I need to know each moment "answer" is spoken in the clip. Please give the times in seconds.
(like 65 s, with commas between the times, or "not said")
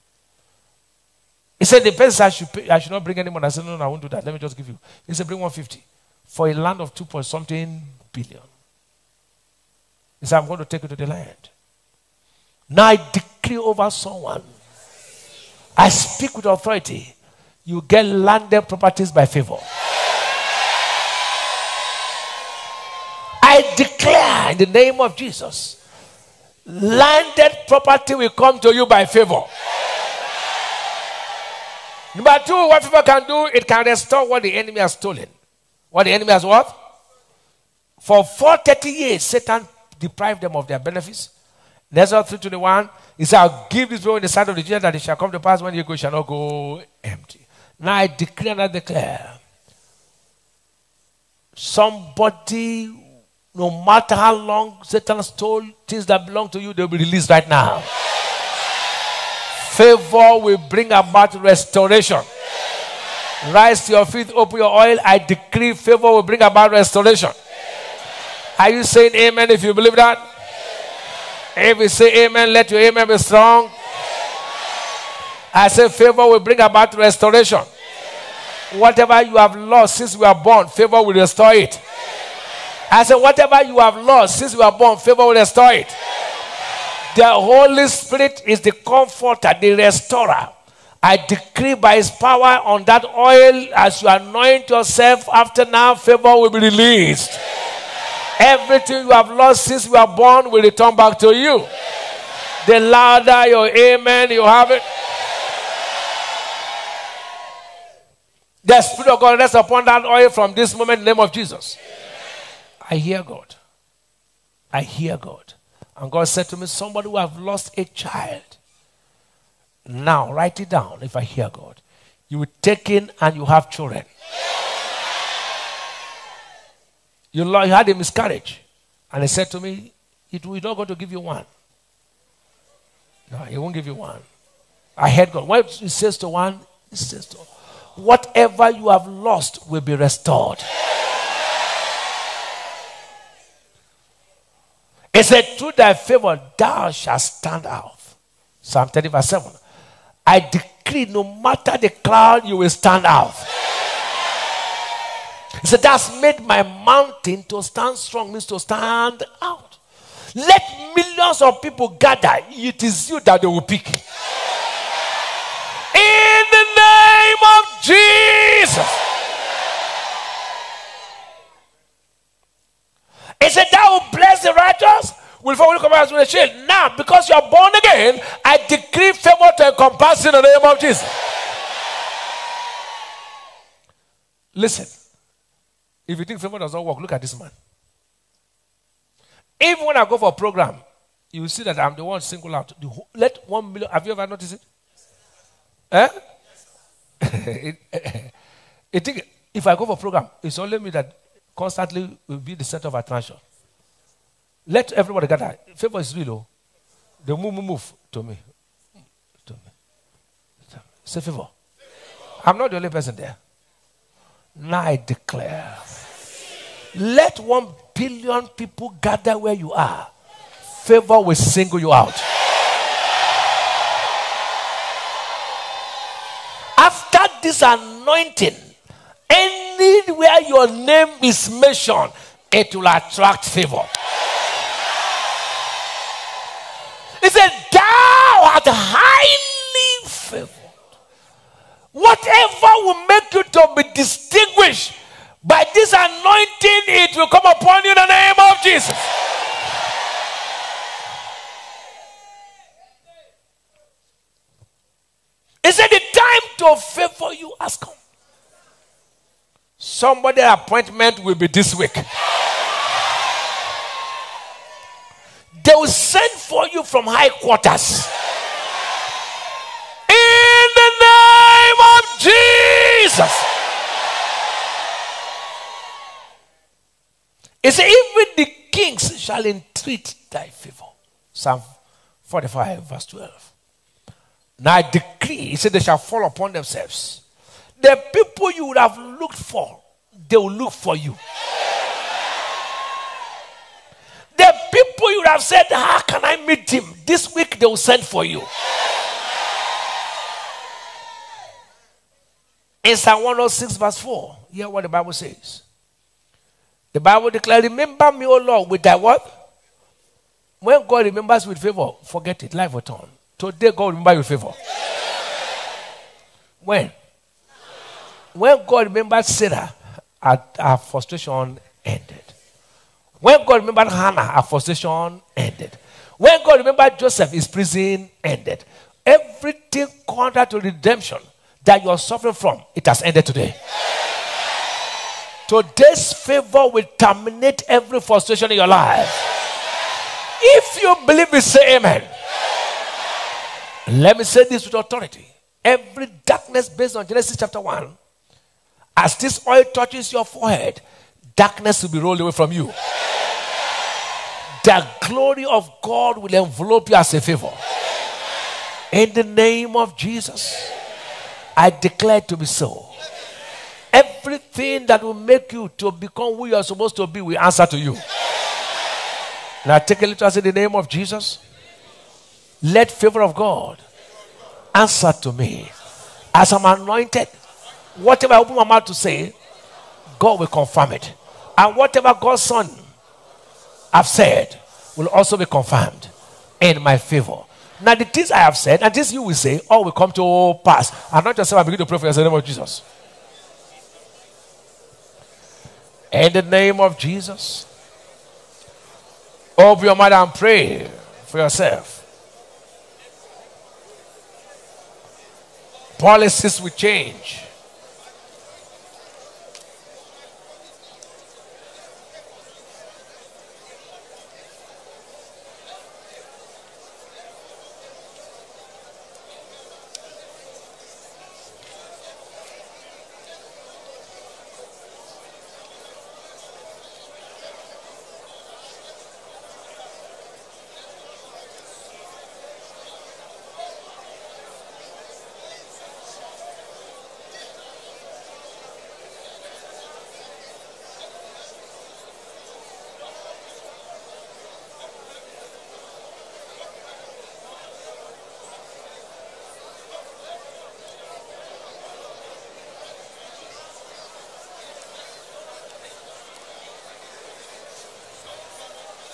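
367 s, 374 s.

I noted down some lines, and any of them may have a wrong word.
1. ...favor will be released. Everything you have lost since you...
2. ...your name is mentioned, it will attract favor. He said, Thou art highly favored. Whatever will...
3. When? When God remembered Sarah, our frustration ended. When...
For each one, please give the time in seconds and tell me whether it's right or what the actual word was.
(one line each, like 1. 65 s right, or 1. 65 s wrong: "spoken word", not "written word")
1. 95 s right
2. 230 s right
3. 316 s right.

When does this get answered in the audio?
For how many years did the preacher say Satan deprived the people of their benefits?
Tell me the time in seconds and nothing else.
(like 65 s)
38 s.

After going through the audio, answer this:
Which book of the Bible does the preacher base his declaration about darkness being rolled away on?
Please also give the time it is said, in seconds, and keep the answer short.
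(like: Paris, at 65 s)
Genesis, at 347 s.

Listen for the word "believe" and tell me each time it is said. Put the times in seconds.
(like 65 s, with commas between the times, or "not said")
69 s, 341 s.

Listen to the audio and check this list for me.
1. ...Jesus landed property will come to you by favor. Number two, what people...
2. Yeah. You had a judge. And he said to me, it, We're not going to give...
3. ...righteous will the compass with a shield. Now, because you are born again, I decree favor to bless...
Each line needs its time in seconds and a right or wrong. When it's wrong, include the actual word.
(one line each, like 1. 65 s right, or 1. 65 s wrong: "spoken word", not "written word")
1. 25 s right
2. 124 s wrong: "miscarriage", not "judge"
3. 174 s wrong: "encompass", not "bless".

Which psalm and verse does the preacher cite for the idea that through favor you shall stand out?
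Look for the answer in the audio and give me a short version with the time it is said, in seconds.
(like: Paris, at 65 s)
Psalm 30:7, at 148 s.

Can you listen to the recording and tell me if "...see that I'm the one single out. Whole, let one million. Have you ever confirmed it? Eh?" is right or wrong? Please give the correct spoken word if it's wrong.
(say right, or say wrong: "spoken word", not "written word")
wrong: "noticed", not "confirmed".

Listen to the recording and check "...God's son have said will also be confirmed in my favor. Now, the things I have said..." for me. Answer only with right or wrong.
right.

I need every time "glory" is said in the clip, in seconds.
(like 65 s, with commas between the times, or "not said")
355 s.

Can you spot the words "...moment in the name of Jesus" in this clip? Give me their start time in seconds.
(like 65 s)
110 s.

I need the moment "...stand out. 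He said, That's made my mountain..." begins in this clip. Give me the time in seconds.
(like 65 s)
152 s.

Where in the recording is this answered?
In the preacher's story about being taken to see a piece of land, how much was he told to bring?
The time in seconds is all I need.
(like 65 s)
5 s.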